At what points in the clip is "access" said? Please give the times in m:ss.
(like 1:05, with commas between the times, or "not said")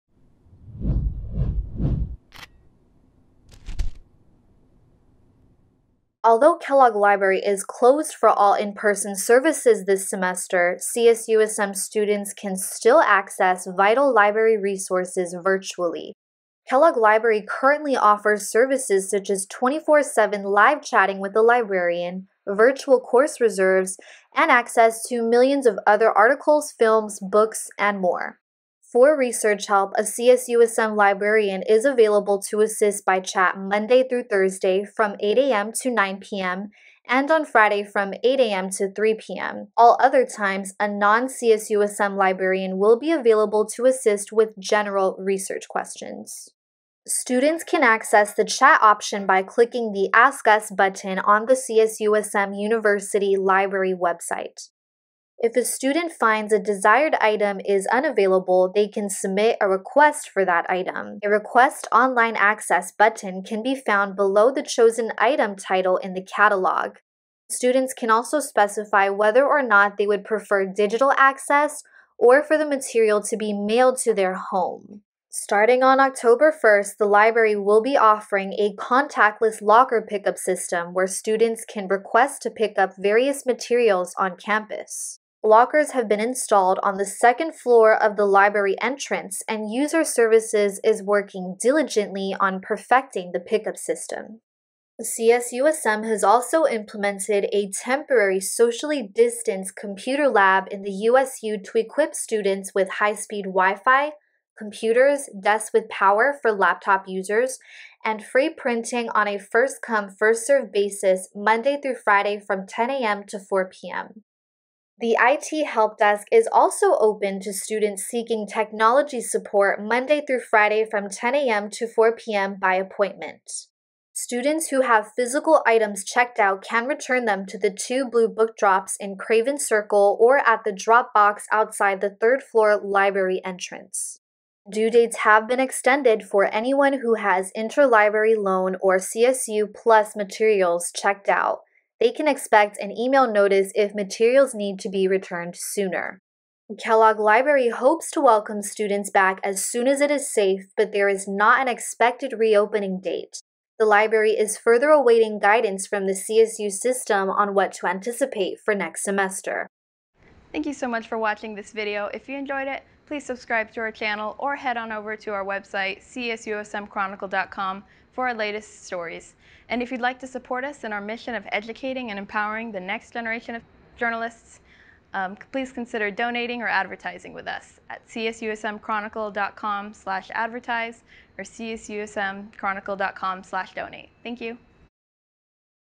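0:13, 0:24, 0:47, 1:02, 1:11.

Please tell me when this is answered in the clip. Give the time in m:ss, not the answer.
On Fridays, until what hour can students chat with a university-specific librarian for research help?
0:38.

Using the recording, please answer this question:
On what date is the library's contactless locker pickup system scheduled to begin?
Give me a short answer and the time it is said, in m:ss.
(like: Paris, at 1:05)
October 1st, at 1:15.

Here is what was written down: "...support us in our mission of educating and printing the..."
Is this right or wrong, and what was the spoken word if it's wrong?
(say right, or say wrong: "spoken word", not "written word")
wrong: "empowering", not "printing".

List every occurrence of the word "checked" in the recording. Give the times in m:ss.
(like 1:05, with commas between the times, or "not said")
2:06, 2:20.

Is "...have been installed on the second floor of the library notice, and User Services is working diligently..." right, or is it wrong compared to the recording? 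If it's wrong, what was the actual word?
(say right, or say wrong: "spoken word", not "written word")
wrong: "entrance", not "notice".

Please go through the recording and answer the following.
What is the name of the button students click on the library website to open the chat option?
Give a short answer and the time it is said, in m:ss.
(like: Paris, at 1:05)
Ask Us, at 0:50.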